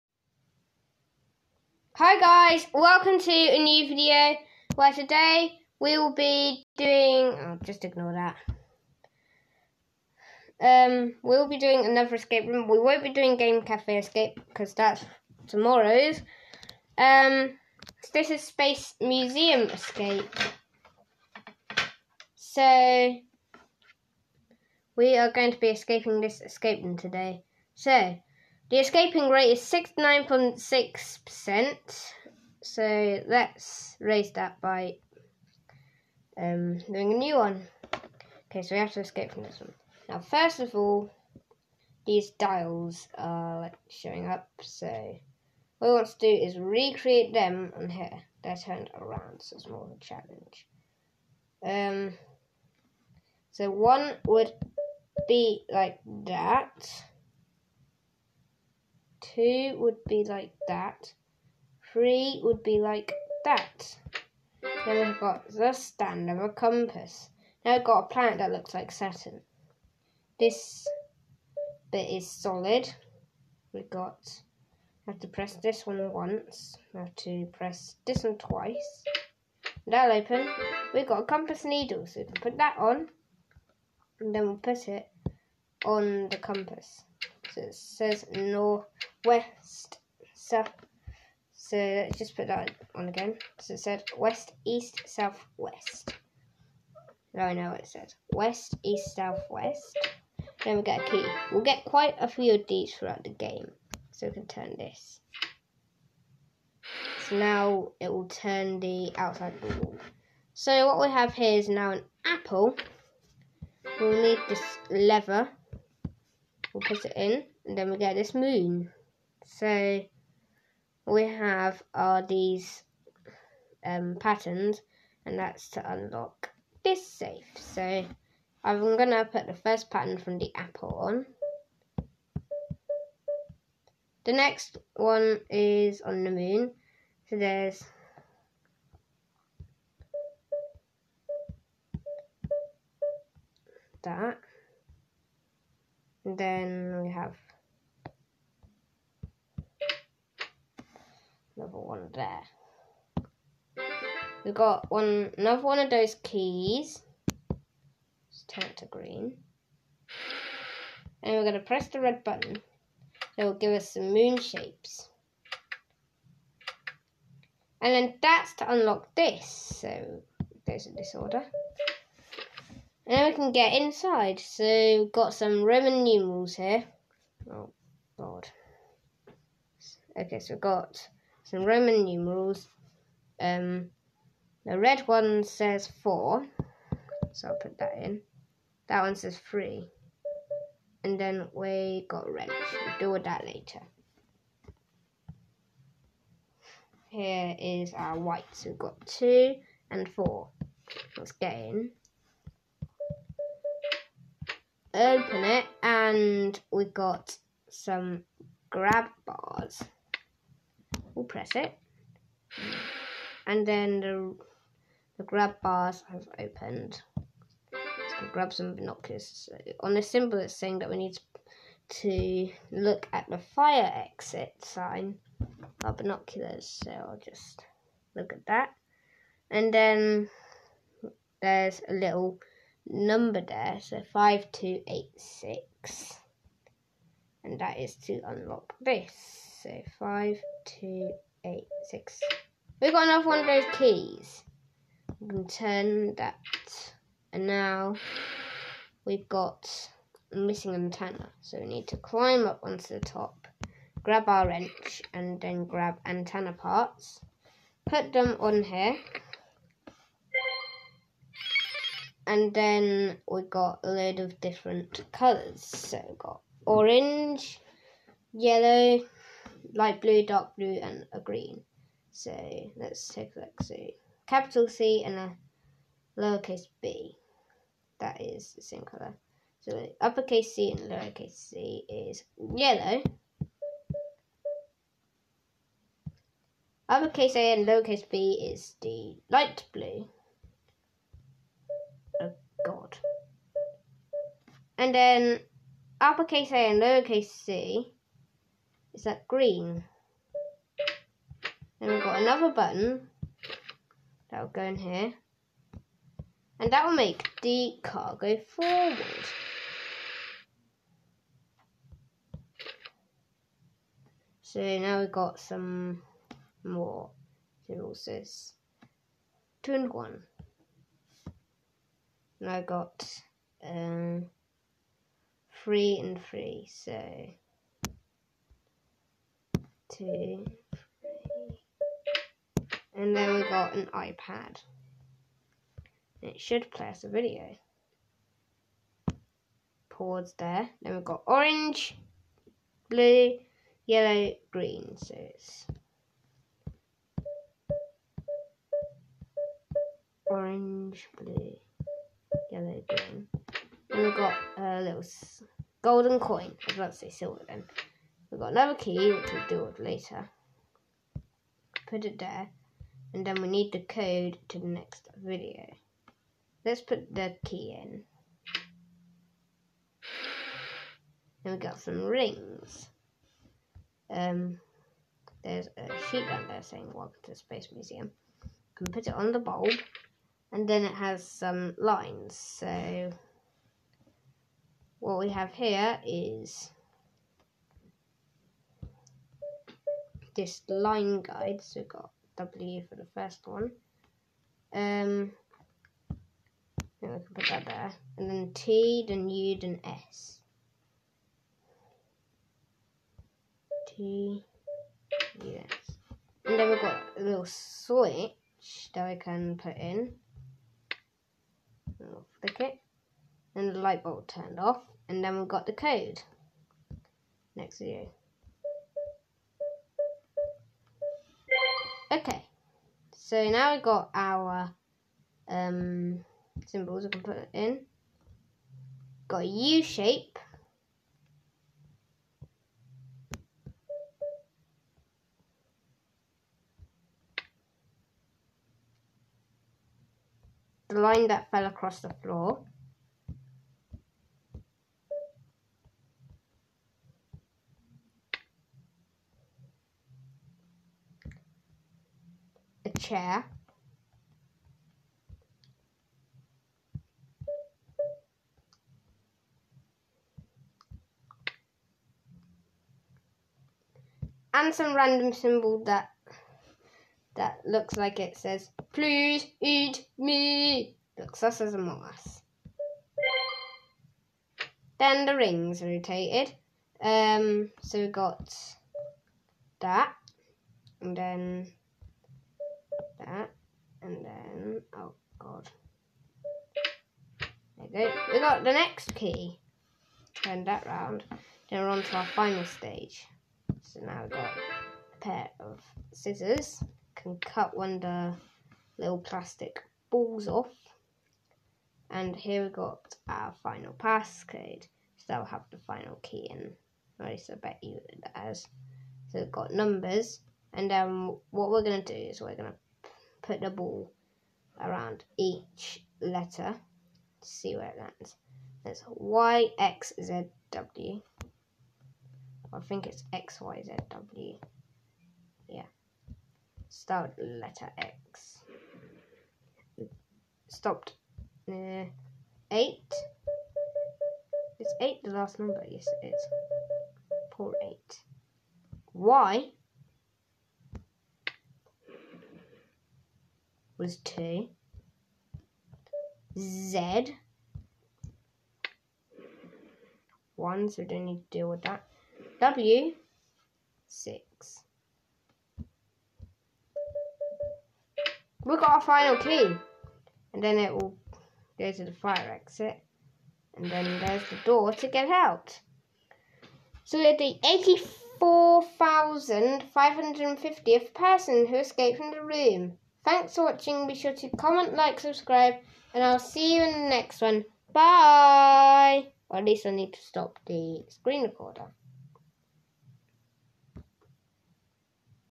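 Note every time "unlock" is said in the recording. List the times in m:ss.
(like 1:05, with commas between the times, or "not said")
2:05, 2:48, 3:58.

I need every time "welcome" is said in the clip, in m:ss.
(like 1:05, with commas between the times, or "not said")
0:02, 6:16.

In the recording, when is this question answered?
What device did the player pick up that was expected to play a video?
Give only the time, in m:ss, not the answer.
5:33.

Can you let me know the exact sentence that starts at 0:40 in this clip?
Now, first of all, these dials are showing up.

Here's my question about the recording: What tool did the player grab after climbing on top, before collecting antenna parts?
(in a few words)
wrench.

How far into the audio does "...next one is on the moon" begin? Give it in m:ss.
2:14.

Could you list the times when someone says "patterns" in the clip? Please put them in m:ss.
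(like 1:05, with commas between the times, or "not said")
2:04, 2:09.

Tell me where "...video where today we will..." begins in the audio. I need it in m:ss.
0:03.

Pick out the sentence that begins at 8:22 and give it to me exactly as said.
And here we got our final passcode.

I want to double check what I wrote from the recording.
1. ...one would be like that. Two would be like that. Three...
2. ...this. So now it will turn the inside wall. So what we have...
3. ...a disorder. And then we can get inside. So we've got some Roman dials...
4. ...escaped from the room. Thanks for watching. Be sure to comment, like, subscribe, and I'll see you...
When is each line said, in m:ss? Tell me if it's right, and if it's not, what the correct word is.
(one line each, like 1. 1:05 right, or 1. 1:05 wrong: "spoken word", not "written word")
1. 0:53 right
2. 1:44 wrong: "outside", not "inside"
3. 2:50 wrong: "numerals", not "dials"
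4. 9:31 right.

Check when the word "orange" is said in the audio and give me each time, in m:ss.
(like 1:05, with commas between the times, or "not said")
4:26, 5:41, 5:50.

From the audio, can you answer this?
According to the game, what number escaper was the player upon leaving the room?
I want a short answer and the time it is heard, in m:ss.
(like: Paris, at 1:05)
84,550th, at 9:28.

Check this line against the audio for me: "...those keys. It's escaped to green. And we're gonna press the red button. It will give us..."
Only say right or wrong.
wrong.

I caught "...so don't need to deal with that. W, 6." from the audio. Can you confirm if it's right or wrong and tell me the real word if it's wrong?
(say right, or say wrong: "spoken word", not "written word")
right.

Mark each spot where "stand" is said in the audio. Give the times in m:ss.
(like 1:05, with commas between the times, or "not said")
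1:05.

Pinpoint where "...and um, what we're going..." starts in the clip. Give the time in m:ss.
8:30.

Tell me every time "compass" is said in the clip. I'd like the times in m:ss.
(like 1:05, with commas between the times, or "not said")
1:06, 1:21, 1:26.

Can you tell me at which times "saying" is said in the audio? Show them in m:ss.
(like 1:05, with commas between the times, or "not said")
3:40, 6:16.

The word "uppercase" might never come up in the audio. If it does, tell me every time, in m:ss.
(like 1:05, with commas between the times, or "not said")
4:40, 4:46, 4:56.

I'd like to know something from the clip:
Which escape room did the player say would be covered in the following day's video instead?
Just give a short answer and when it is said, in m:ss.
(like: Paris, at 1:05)
Game Cafe Escape, at 0:13.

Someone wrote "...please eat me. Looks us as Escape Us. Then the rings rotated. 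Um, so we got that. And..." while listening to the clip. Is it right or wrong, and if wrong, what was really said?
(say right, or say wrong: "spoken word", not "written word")
wrong: "Among", not "Escape".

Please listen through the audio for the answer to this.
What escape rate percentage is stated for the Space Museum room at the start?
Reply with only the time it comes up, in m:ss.
0:29.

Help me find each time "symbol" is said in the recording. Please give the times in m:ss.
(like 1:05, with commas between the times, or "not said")
3:40, 7:06, 7:45.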